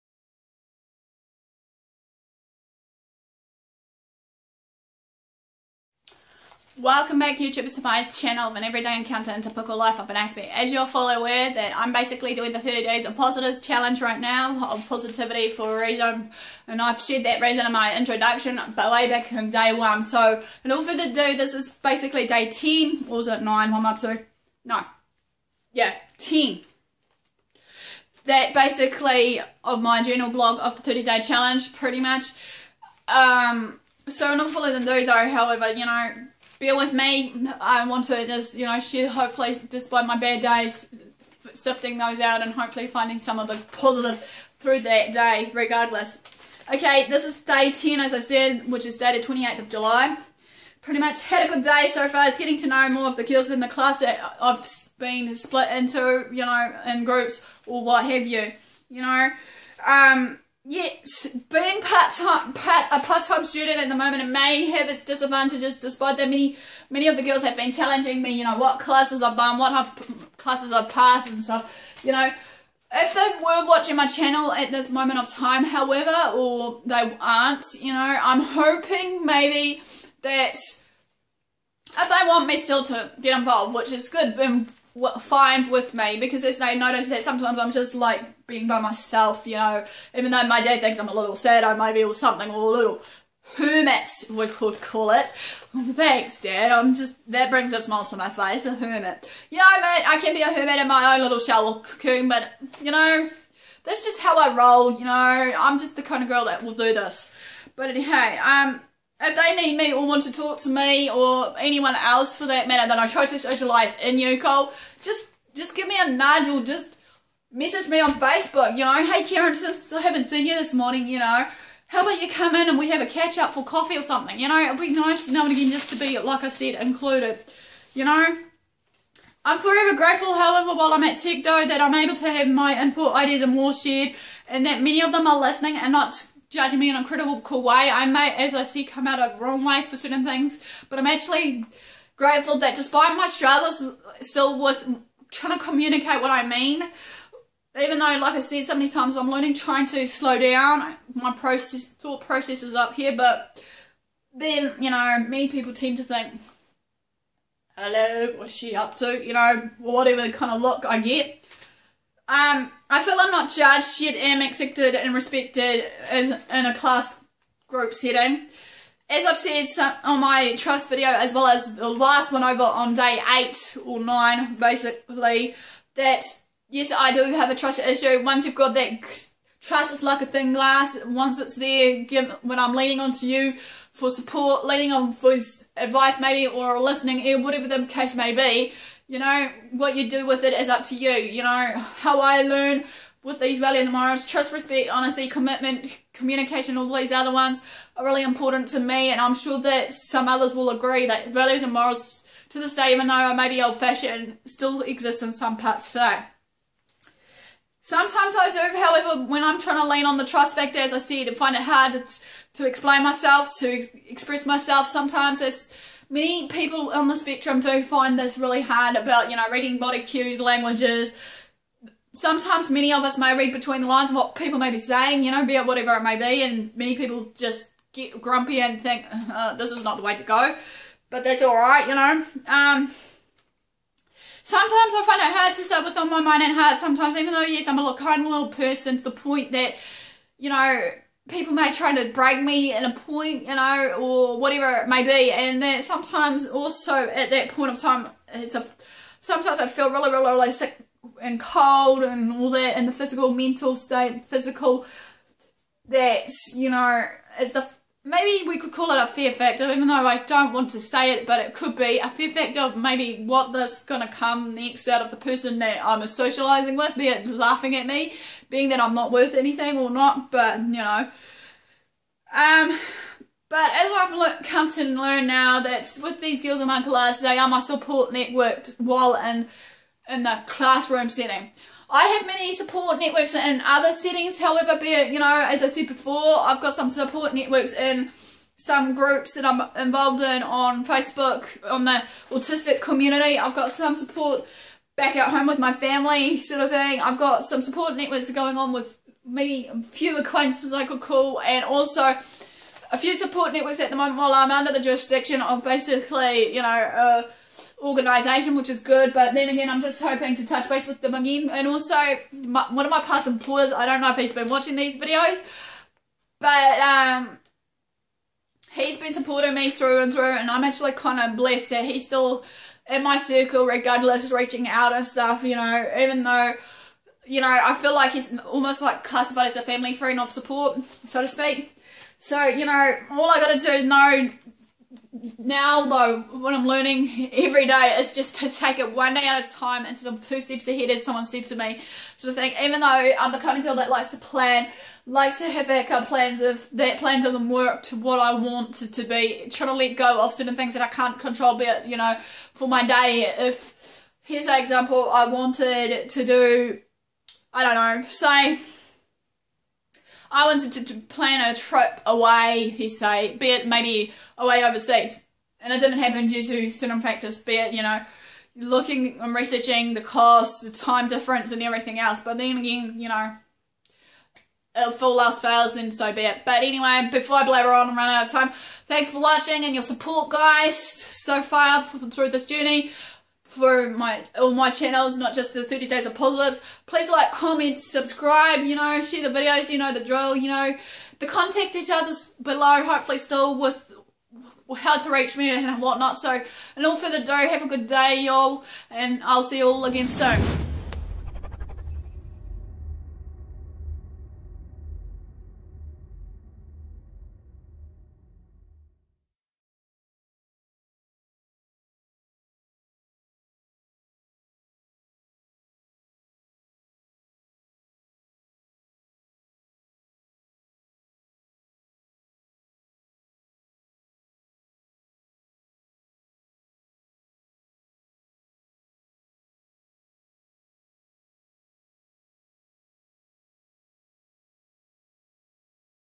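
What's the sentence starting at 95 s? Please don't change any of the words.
Thanks dad, I'm just, that brings a smile to my face, a hermit.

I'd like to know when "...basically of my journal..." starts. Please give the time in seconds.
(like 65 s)
28 s.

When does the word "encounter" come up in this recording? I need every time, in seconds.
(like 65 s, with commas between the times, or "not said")
8 s.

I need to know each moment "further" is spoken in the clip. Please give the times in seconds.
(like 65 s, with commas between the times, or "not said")
20 s, 396 s.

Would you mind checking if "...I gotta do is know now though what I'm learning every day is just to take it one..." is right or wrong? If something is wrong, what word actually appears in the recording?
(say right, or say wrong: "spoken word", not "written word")
right.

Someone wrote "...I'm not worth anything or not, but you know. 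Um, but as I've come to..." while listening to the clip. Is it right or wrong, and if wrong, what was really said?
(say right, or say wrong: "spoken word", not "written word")
right.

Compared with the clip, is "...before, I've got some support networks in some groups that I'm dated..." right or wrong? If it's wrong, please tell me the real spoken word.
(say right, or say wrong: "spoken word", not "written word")
wrong: "involved", not "dated".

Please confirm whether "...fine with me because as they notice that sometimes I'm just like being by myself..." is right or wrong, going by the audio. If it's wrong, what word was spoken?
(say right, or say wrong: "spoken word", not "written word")
right.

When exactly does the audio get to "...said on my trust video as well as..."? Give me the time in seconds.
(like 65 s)
169 s.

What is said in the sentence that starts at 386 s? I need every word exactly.
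Please like, comment, subscribe, you know, share the videos, you know, the drill, you know.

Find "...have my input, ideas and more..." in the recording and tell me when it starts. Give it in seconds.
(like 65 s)
132 s.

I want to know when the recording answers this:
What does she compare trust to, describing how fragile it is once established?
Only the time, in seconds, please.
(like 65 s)
180 s.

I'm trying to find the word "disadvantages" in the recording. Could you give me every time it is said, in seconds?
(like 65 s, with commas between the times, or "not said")
65 s.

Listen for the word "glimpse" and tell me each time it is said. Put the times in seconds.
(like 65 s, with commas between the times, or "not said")
not said.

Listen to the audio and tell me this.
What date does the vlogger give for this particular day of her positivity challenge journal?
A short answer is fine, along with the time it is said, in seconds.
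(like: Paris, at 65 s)
28th of July, at 49 s.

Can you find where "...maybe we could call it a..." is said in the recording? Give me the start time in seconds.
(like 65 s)
258 s.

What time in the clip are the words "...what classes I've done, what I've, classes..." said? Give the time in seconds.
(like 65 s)
68 s.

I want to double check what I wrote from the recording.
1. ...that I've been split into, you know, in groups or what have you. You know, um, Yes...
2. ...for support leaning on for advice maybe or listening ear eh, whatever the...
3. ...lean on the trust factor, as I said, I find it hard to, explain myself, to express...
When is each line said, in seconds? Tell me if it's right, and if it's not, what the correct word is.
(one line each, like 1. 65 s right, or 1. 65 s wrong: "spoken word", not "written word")
1. 53 s right
2. 183 s right
3. 209 s right.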